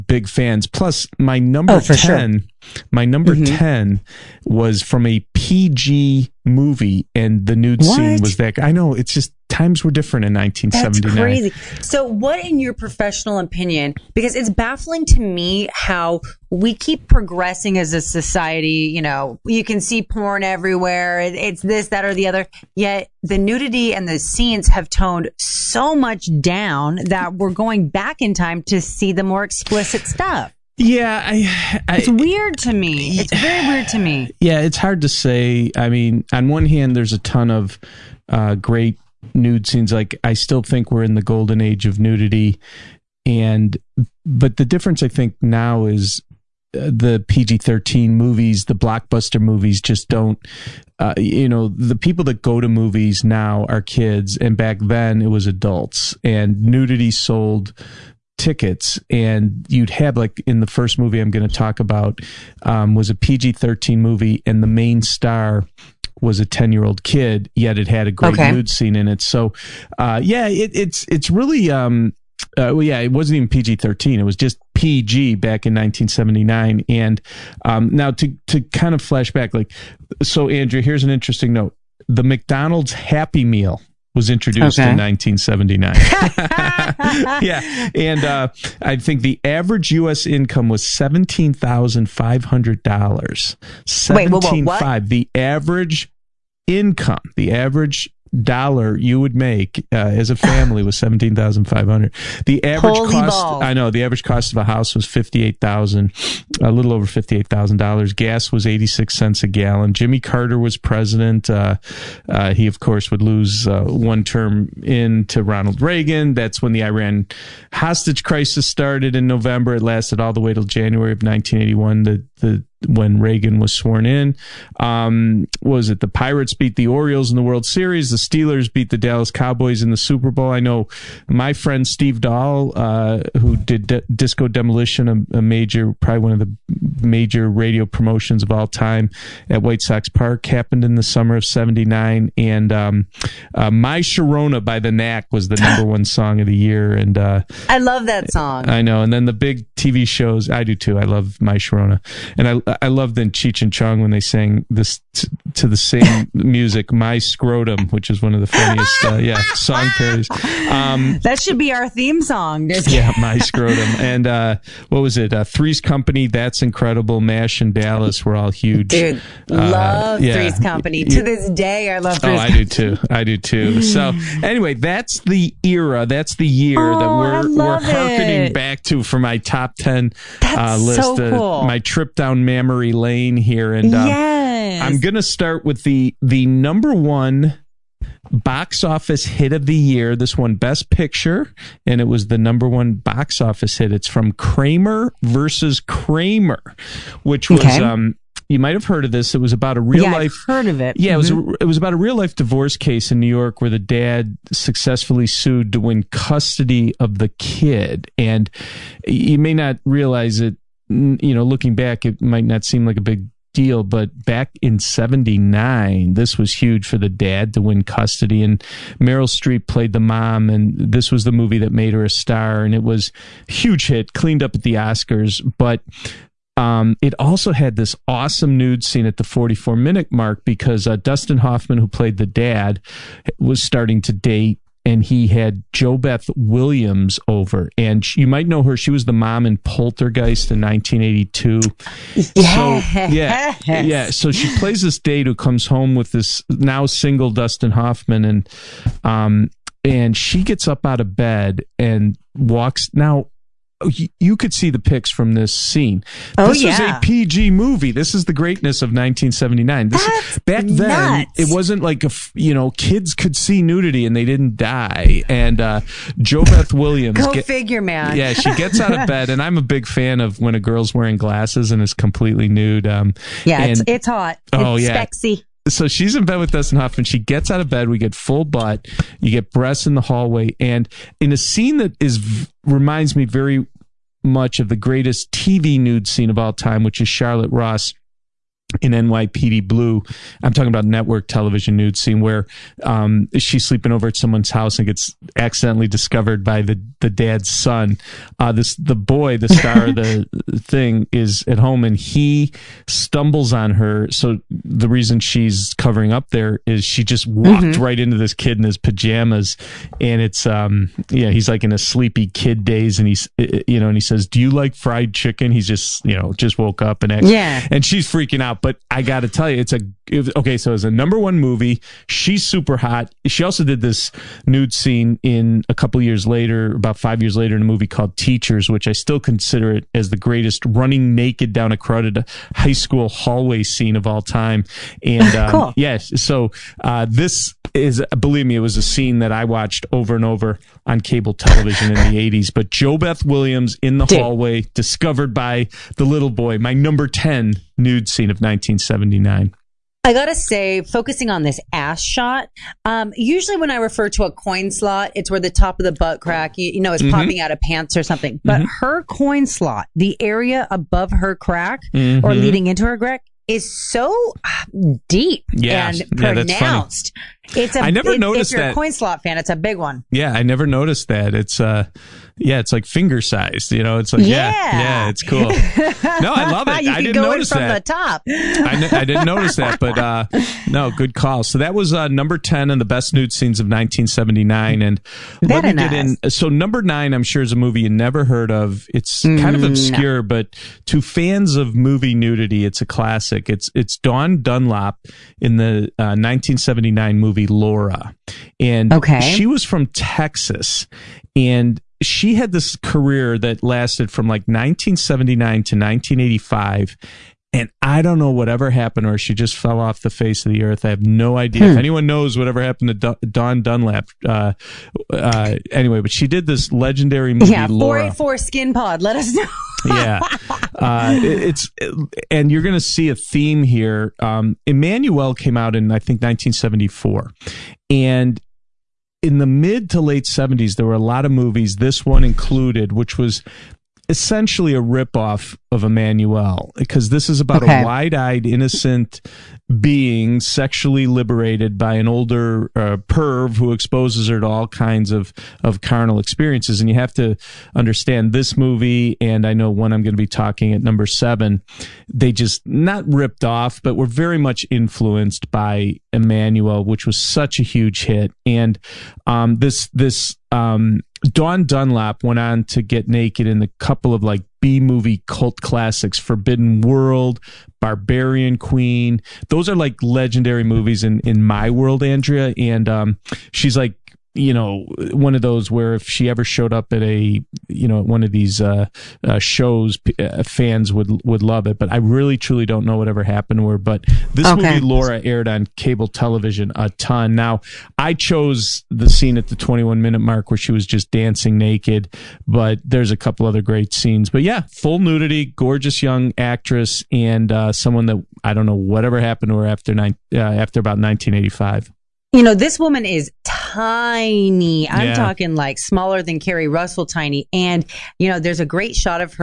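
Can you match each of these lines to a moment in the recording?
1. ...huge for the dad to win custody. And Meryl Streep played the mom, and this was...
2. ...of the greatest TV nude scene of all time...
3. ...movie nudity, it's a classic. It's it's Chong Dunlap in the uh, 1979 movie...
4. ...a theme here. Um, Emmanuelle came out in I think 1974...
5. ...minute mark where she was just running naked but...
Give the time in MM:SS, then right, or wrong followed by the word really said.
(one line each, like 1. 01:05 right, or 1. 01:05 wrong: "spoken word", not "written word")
1. 03:36 right
2. 04:44 right
3. 06:31 wrong: "Dawn", not "Chong"
4. 07:03 right
5. 08:10 wrong: "dancing", not "running".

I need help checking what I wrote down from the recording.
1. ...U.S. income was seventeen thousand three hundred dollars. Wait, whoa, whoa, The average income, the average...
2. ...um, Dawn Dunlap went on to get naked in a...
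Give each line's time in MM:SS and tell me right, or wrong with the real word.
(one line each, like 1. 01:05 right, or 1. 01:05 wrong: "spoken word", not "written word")
1. 01:29 wrong: "five", not "three"
2. 07:40 right.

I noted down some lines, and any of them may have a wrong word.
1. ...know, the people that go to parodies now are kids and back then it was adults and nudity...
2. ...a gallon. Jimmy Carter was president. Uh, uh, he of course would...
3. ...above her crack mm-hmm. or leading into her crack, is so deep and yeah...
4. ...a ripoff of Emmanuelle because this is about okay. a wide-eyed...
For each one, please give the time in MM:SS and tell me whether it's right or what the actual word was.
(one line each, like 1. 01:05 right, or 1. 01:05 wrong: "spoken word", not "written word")
1. 00:51 wrong: "movies", not "parodies"
2. 01:49 right
3. 06:00 right
4. 07:14 right.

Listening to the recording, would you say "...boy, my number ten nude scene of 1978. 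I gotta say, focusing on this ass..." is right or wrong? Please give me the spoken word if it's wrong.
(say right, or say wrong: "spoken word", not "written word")
wrong: "1979", not "1978".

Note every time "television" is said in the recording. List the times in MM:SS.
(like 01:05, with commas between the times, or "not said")
04:51, 05:41, 08:06.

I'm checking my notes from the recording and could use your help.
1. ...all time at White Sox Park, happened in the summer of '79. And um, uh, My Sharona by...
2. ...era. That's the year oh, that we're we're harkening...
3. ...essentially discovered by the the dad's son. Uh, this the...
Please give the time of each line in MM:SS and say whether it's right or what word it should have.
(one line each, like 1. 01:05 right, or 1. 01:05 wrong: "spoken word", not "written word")
1. 02:18 right
2. 02:55 right
3. 04:55 wrong: "accidentally", not "essentially".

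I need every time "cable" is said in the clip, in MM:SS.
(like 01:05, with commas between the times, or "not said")
05:41, 08:05.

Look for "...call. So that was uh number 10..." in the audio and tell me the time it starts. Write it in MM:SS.
06:21.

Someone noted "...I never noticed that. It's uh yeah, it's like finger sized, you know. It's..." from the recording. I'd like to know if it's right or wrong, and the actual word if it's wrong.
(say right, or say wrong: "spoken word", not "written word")
right.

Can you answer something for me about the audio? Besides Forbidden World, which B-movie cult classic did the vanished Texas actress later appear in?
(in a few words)
Barbarian Queen.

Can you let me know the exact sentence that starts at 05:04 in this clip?
So the reason she's covering up there is she just walked mm-hmm.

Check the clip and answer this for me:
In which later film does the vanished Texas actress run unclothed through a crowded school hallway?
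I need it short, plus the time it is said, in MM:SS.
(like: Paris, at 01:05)
Teachers, at 05:28.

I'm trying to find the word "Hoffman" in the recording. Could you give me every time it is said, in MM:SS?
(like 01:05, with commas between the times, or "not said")
03:51, 04:07, 04:36.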